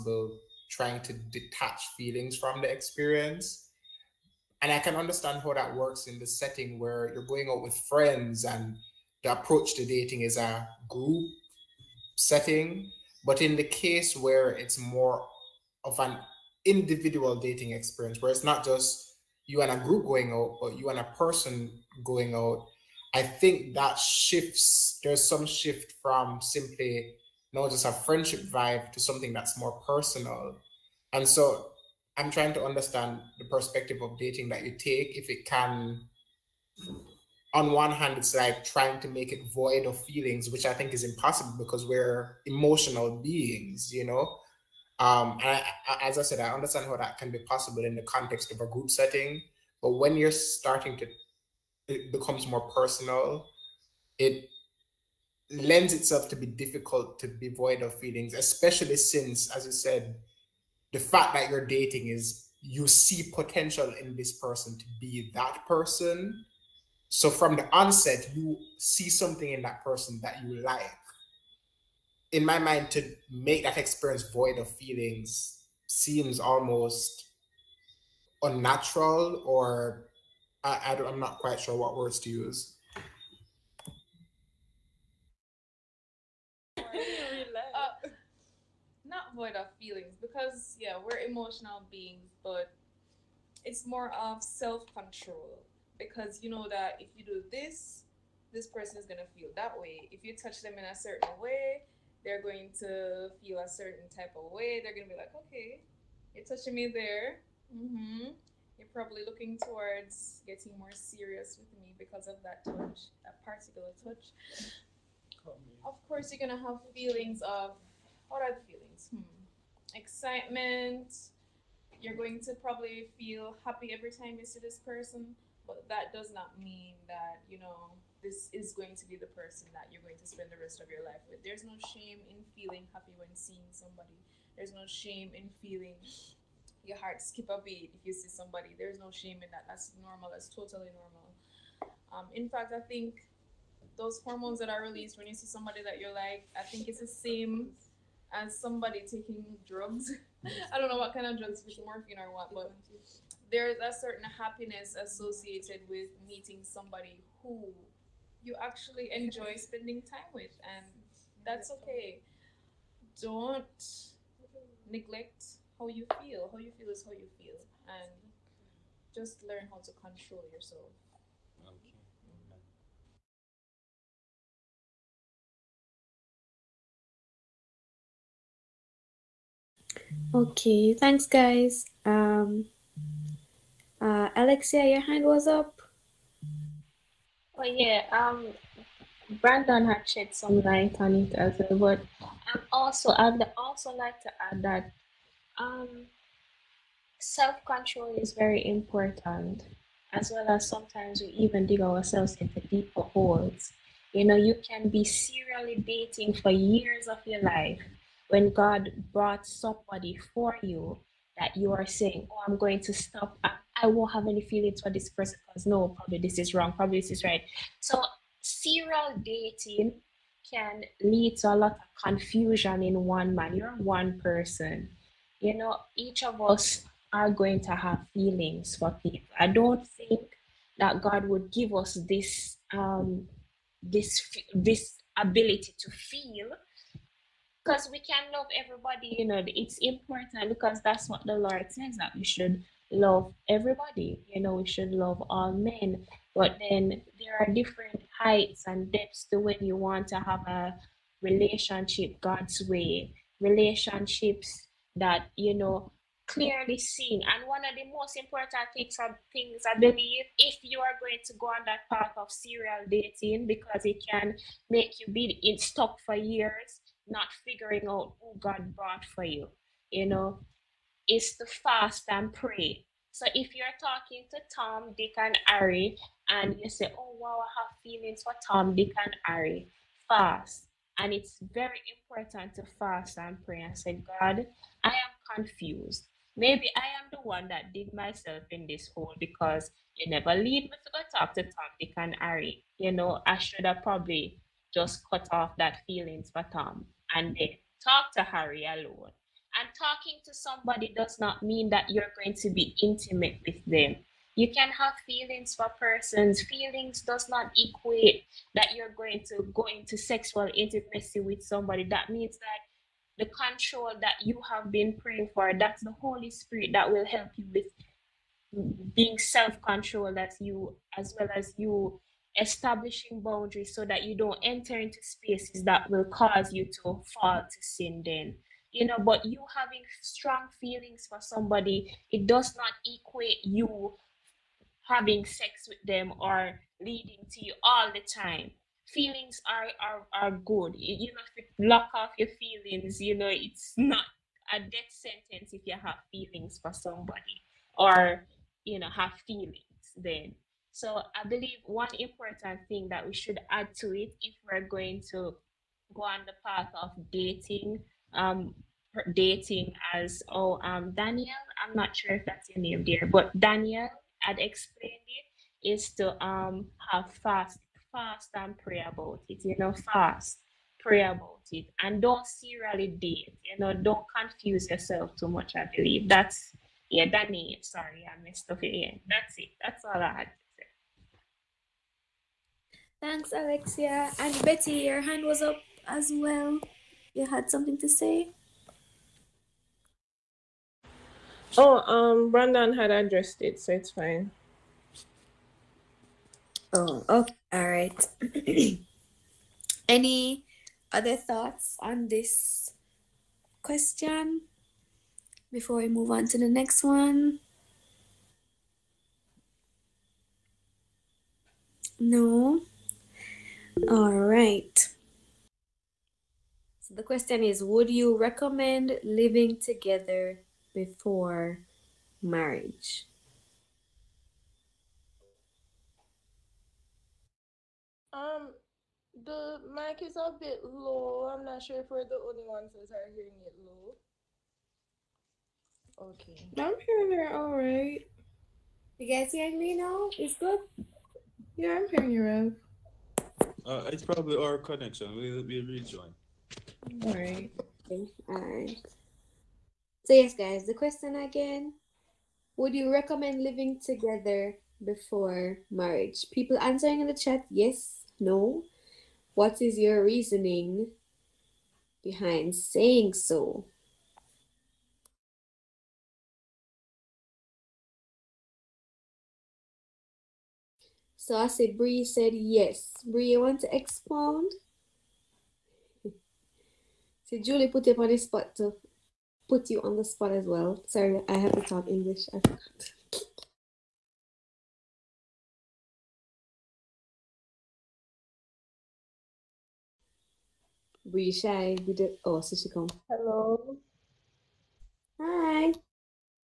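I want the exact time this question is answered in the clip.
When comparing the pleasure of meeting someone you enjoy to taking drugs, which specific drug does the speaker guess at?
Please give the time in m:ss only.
2:31.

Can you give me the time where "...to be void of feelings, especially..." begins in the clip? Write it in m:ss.
0:57.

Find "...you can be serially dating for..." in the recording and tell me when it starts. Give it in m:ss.
3:24.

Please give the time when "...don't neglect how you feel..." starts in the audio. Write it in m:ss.
2:43.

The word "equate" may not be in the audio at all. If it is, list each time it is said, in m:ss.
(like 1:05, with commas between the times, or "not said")
5:07, 5:32.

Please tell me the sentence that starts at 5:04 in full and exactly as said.
You can have feelings for persons.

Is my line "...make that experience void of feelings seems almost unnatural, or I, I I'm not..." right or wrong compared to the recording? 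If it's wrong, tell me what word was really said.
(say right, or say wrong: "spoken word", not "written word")
right.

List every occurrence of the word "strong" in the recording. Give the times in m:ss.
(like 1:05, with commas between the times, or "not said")
5:30.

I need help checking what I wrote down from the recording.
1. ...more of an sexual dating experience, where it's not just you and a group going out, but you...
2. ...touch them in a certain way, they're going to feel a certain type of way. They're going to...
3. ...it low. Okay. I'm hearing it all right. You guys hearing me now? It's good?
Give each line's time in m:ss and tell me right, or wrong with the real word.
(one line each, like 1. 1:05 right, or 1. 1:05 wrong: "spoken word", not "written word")
1. 0:14 wrong: "individual", not "sexual"
2. 1:40 right
3. 7:13 right.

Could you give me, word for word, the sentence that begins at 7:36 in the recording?
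People answering in the chat yes, no.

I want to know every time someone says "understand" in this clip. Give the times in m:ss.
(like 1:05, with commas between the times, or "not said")
0:04, 0:32, 0:46.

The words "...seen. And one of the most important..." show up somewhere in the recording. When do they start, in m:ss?
4:16.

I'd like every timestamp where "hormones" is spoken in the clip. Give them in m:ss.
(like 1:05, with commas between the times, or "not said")
2:24.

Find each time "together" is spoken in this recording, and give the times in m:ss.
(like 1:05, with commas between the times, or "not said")
6:59, 7:33.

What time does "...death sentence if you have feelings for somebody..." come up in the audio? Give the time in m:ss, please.
5:44.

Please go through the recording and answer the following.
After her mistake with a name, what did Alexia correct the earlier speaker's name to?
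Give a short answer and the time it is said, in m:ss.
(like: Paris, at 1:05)
Danny, at 6:17.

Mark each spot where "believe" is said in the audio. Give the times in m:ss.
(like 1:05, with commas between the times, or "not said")
4:19, 5:51, 6:15.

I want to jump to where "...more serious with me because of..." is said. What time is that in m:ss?
1:50.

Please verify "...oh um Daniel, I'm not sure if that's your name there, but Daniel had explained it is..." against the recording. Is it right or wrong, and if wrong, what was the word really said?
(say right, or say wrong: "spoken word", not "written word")
right.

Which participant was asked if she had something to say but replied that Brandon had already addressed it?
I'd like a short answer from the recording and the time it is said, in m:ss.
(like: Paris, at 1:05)
Betty, at 6:24.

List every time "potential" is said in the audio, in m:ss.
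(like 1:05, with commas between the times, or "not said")
1:03.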